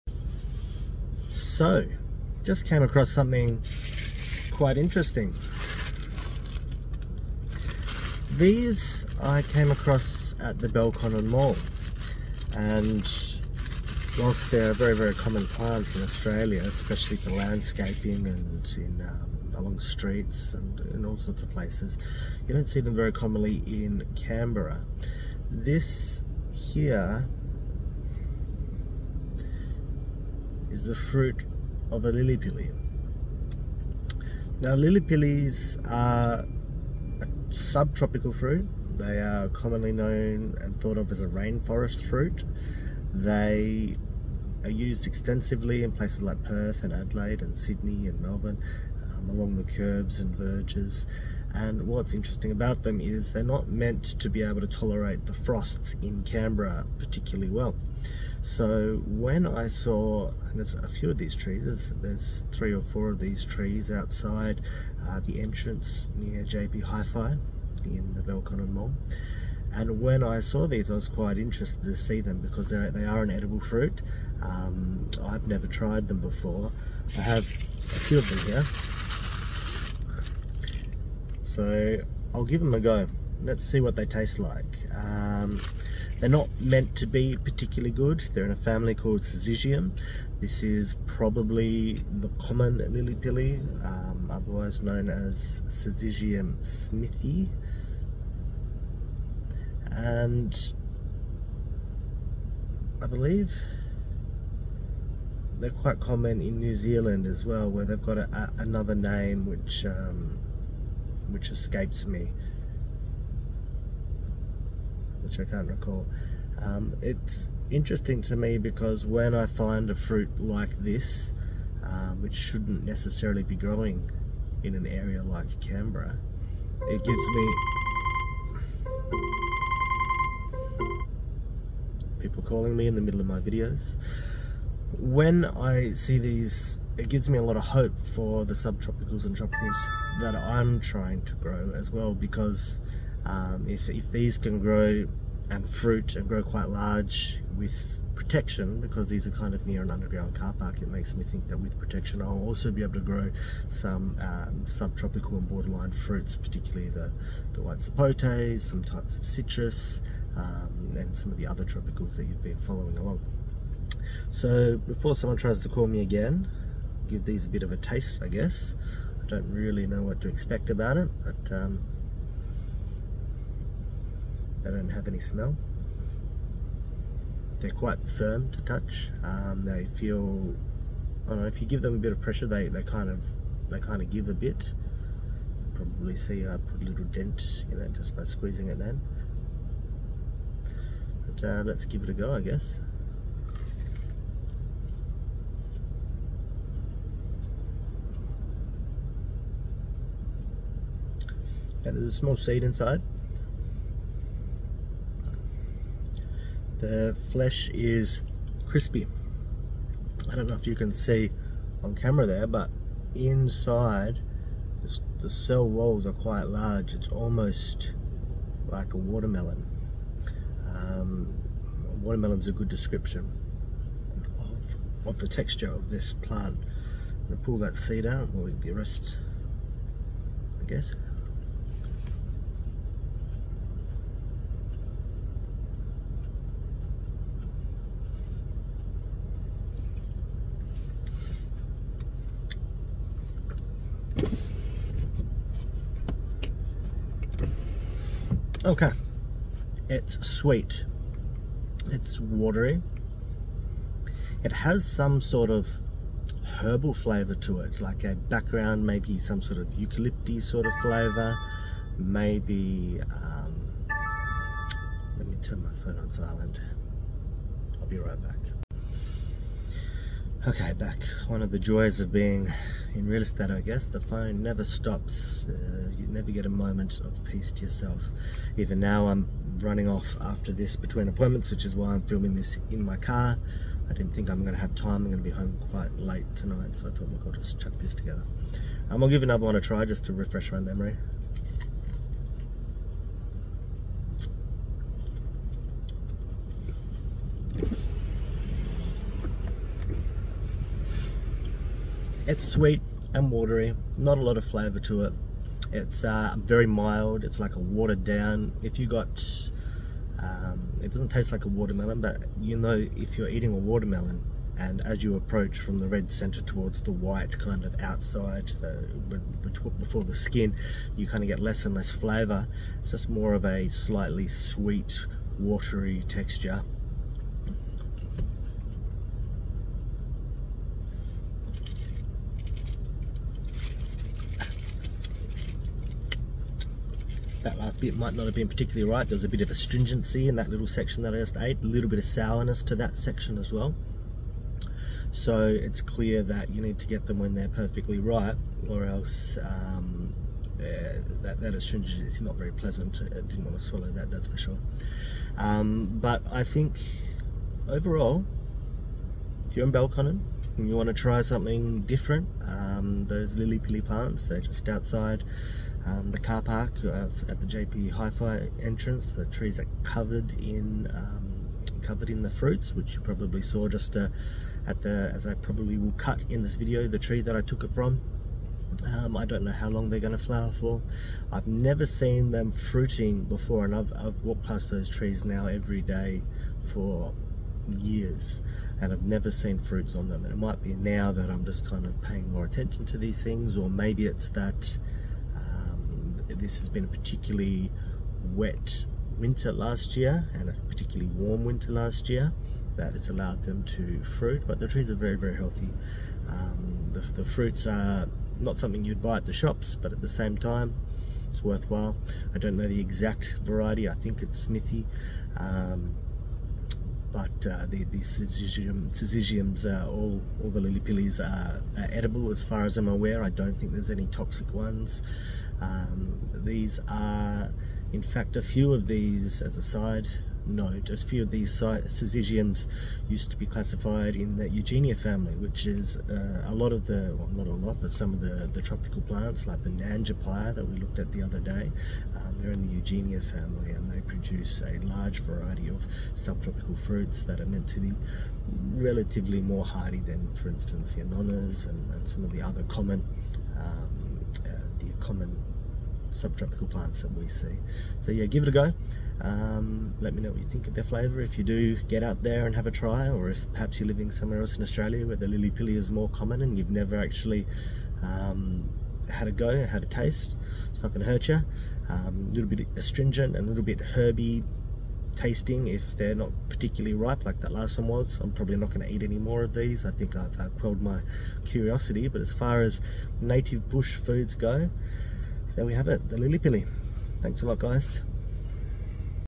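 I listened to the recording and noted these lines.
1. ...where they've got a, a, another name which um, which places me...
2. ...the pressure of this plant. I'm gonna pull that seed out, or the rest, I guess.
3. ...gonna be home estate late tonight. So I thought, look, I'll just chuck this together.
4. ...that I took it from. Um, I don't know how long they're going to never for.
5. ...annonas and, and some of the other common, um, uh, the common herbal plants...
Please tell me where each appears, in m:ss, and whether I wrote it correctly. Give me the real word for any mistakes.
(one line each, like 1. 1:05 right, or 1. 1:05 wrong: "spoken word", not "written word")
1. 1:47 wrong: "escapes", not "places"
2. 3:45 wrong: "texture", not "pressure"
3. 4:45 wrong: "quite", not "estate"
4. 6:17 wrong: "flower", not "never"
5. 7:31 wrong: "subtropical", not "herbal".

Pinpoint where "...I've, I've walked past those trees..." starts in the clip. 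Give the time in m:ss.
6:23.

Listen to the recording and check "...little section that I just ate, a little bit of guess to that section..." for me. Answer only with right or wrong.
wrong.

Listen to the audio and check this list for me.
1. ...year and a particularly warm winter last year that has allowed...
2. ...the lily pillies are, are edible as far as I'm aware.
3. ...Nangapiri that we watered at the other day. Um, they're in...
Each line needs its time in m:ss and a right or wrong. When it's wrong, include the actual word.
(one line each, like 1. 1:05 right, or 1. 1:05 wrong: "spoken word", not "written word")
1. 6:39 right
2. 7:00 right
3. 7:19 wrong: "looked", not "watered".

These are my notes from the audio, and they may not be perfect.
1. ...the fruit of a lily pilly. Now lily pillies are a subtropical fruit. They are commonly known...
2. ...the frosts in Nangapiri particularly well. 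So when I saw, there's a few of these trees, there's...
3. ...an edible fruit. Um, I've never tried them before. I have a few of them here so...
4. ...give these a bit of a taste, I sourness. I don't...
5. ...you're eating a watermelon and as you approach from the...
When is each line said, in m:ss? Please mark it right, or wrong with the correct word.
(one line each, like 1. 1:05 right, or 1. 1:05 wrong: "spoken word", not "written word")
1. 0:30 right
2. 0:55 wrong: "Canberra", not "Nangapiri"
3. 1:13 right
4. 2:47 wrong: "guess", not "sourness"
5. 5:13 right.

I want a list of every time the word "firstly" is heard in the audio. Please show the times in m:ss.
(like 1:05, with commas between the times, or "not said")
not said.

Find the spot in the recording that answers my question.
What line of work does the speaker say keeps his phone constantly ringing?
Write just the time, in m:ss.
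4:33.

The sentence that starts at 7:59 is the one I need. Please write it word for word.
I think I've uh, quelled my curiosity but as far as native bush foods go there we have it, the Lily Pilly.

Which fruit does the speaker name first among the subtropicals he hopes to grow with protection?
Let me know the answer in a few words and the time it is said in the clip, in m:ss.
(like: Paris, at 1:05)
White sapotes, at 2:37.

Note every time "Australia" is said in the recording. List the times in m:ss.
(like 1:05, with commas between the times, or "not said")
0:16, 7:44.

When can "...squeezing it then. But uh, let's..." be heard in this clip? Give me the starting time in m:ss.
3:08.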